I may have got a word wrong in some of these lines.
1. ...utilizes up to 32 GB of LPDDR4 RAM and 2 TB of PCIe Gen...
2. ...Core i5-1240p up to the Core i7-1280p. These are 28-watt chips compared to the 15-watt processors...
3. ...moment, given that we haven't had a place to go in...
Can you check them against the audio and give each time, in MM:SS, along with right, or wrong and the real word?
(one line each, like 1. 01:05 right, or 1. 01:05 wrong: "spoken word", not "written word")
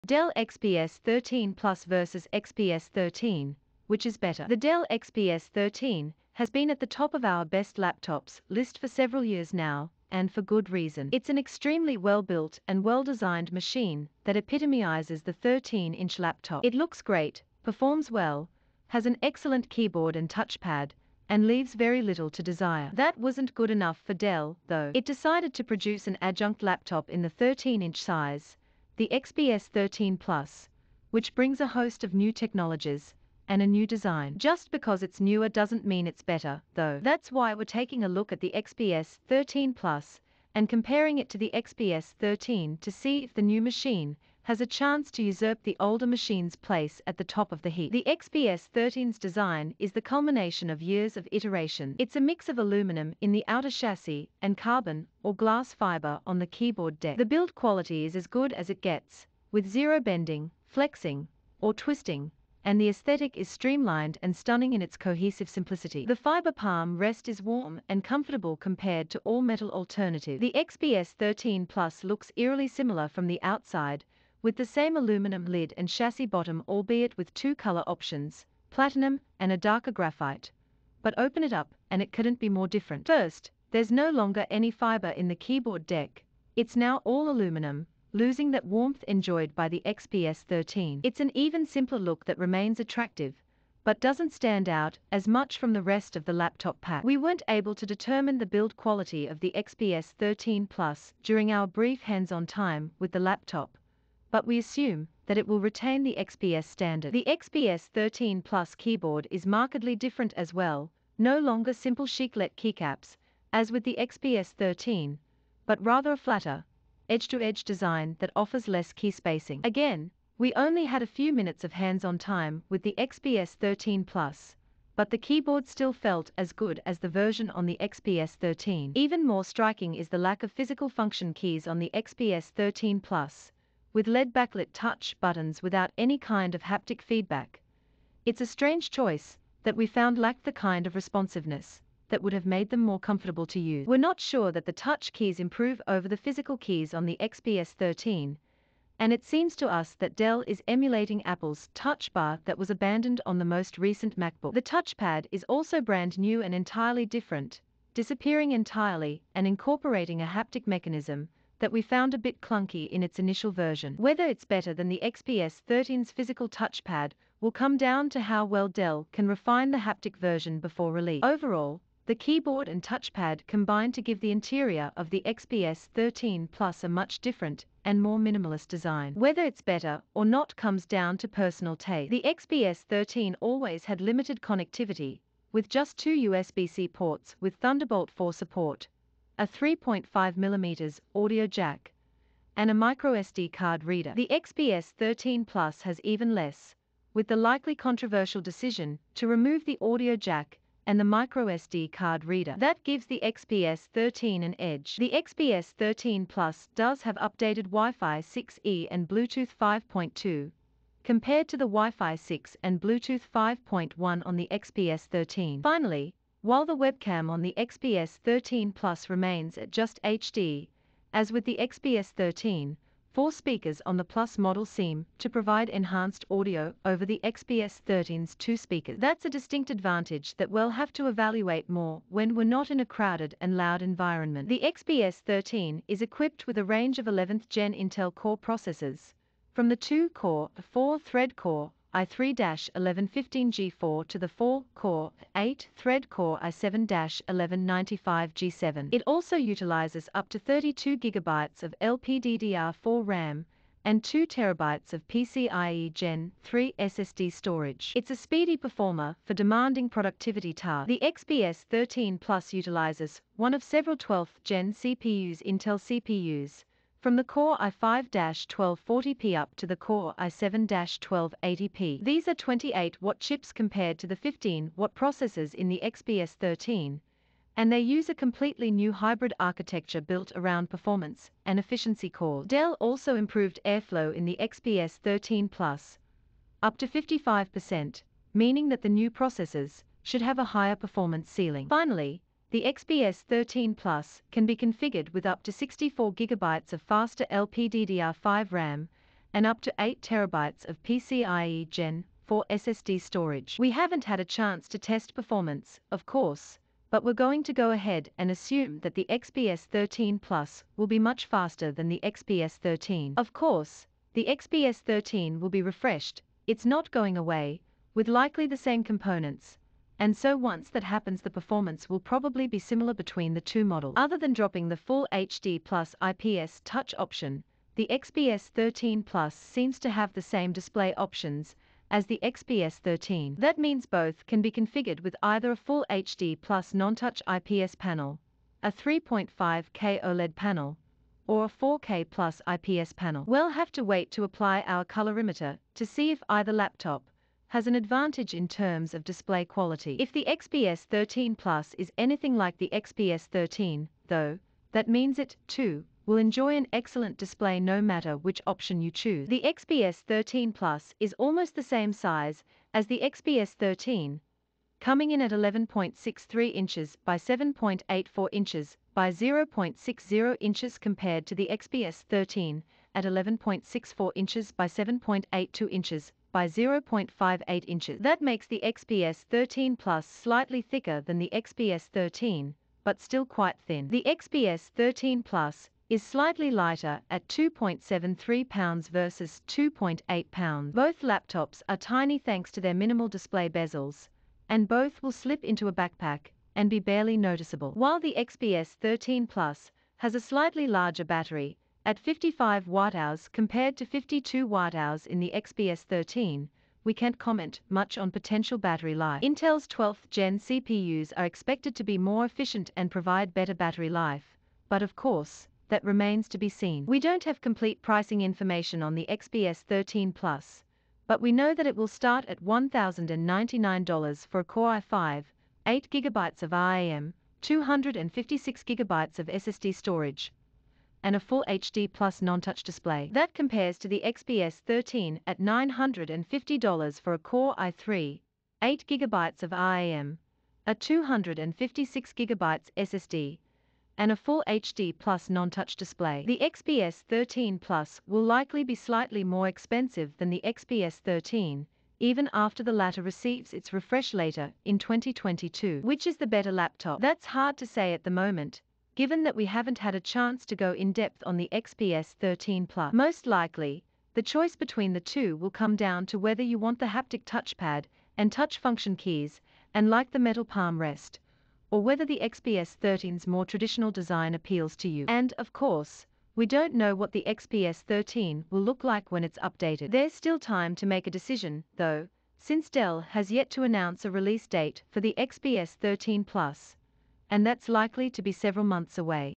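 1. 04:09 right
2. 04:27 right
3. 07:38 wrong: "chance", not "place".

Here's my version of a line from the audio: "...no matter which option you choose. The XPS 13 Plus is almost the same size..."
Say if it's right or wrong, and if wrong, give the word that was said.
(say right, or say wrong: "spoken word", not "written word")
right.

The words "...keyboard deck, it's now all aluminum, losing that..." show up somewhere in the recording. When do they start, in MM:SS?
01:25.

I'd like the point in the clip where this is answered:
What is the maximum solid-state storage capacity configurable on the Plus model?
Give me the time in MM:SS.
04:59.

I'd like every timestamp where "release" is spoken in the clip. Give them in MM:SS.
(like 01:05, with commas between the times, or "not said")
02:50, 08:04.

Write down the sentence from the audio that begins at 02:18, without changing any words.
It's a strange choice that we found lacked the kind of responsiveness that would have made them more comfortable to use.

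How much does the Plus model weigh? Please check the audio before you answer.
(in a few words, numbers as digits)
2.73 pounds.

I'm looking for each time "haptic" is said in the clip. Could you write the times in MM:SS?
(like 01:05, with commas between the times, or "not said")
02:16, 02:40, 02:49, 07:46.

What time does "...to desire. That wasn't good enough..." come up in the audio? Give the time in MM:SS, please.
00:22.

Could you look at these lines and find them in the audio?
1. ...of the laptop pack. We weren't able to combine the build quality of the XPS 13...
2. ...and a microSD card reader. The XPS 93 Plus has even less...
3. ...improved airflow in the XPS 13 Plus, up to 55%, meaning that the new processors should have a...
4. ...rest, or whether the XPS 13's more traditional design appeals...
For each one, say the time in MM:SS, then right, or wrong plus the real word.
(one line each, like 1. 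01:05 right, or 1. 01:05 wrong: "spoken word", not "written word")
1. 01:36 wrong: "determine", not "combine"
2. 03:12 wrong: "13", not "93"
3. 04:43 right
4. 07:50 right.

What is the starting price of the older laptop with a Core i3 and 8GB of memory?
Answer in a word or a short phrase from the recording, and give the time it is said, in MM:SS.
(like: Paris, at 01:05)
$950, at 07:15.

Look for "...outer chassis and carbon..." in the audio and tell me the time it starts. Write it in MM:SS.
00:53.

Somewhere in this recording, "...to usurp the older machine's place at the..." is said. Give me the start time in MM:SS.
00:45.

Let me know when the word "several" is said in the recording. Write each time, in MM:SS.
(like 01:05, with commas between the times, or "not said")
00:08, 04:23, 08:08.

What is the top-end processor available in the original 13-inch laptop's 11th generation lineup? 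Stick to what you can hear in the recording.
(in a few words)
Core i7-1195G7.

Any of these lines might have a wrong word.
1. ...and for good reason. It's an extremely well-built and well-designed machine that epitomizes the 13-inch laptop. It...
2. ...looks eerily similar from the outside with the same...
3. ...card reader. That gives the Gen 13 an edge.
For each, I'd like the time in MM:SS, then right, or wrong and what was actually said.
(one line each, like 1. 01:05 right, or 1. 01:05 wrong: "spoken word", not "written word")
1. 00:10 right
2. 01:12 right
3. 03:21 wrong: "XPS", not "Gen".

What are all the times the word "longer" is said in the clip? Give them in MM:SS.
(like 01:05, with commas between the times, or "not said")
01:24, 01:51.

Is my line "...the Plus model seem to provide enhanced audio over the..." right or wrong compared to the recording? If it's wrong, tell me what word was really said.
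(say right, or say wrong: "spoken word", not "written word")
right.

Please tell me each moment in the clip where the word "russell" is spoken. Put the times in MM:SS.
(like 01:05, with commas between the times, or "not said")
not said.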